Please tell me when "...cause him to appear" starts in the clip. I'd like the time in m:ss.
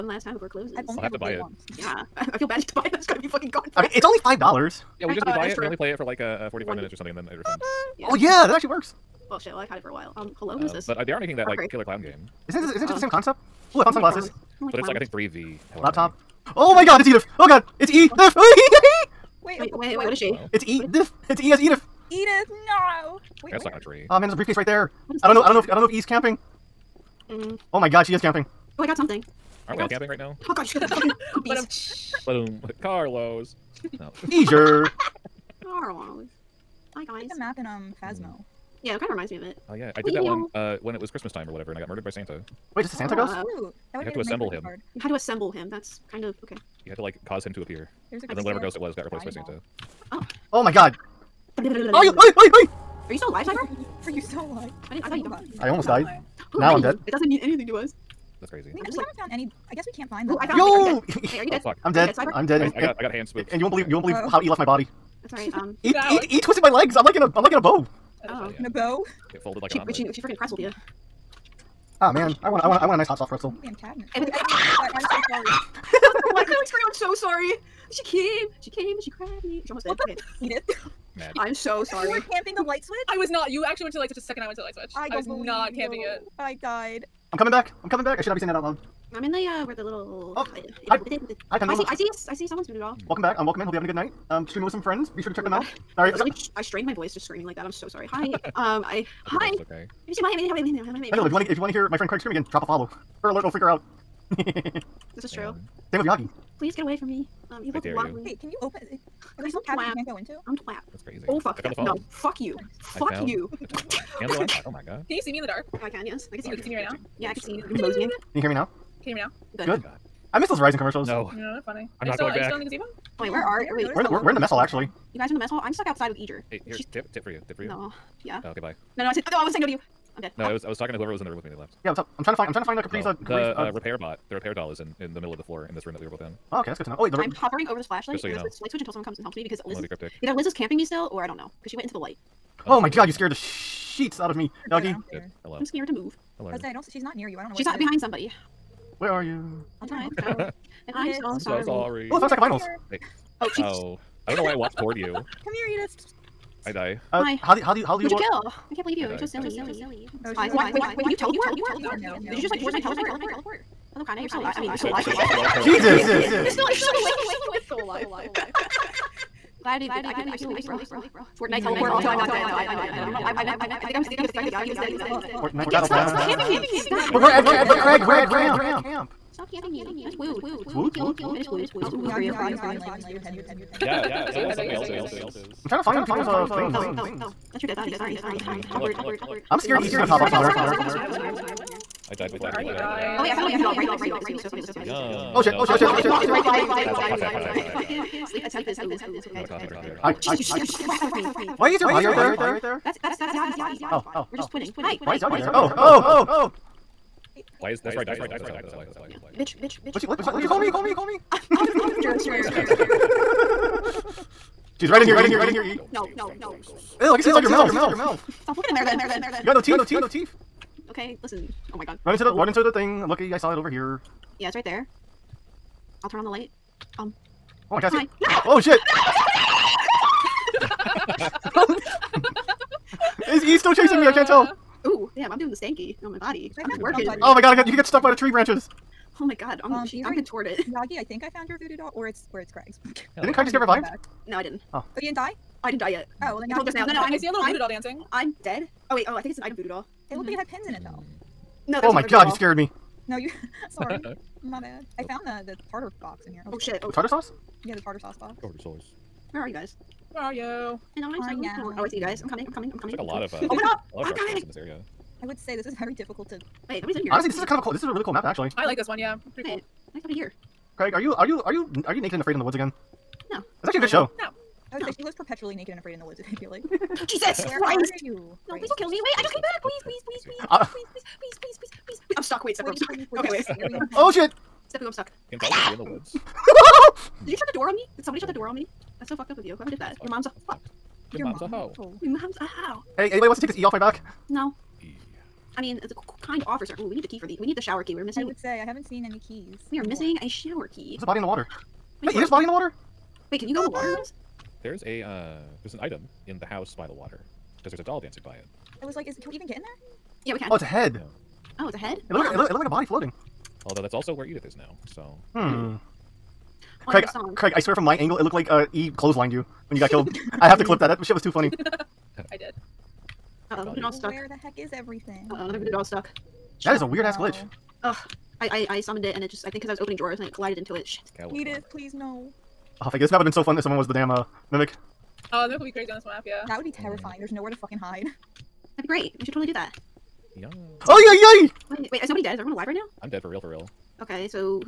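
0:47.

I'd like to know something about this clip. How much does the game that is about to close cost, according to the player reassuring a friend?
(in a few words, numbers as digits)
5 dollars.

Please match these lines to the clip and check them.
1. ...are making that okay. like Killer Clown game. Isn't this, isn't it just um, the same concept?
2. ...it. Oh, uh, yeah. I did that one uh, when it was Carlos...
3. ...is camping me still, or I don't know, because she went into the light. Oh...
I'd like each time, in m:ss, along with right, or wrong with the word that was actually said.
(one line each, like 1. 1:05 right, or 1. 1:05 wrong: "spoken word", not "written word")
1. 0:11 right
2. 0:39 wrong: "Christmas", not "Carlos"
3. 2:20 right.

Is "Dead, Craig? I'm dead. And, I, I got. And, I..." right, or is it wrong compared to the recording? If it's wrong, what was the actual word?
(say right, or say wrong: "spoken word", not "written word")
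wrong: "Cyber", not "Craig".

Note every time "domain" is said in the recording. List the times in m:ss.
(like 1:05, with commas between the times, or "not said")
not said.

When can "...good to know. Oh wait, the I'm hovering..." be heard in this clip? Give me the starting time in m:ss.
2:16.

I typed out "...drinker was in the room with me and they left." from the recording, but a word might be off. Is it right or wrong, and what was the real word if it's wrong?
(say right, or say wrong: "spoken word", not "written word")
wrong: "whoever", not "drinker".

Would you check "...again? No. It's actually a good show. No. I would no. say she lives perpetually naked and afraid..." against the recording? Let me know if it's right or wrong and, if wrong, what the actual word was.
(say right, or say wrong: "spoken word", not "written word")
right.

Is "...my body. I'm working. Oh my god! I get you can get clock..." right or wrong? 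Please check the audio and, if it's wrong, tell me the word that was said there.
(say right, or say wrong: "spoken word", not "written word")
wrong: "stuck", not "clock".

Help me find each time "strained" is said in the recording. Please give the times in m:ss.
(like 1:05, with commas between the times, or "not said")
1:36.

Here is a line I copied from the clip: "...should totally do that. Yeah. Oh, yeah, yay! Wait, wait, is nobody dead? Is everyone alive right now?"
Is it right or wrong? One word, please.
right.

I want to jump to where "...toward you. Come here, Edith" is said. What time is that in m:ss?
2:34.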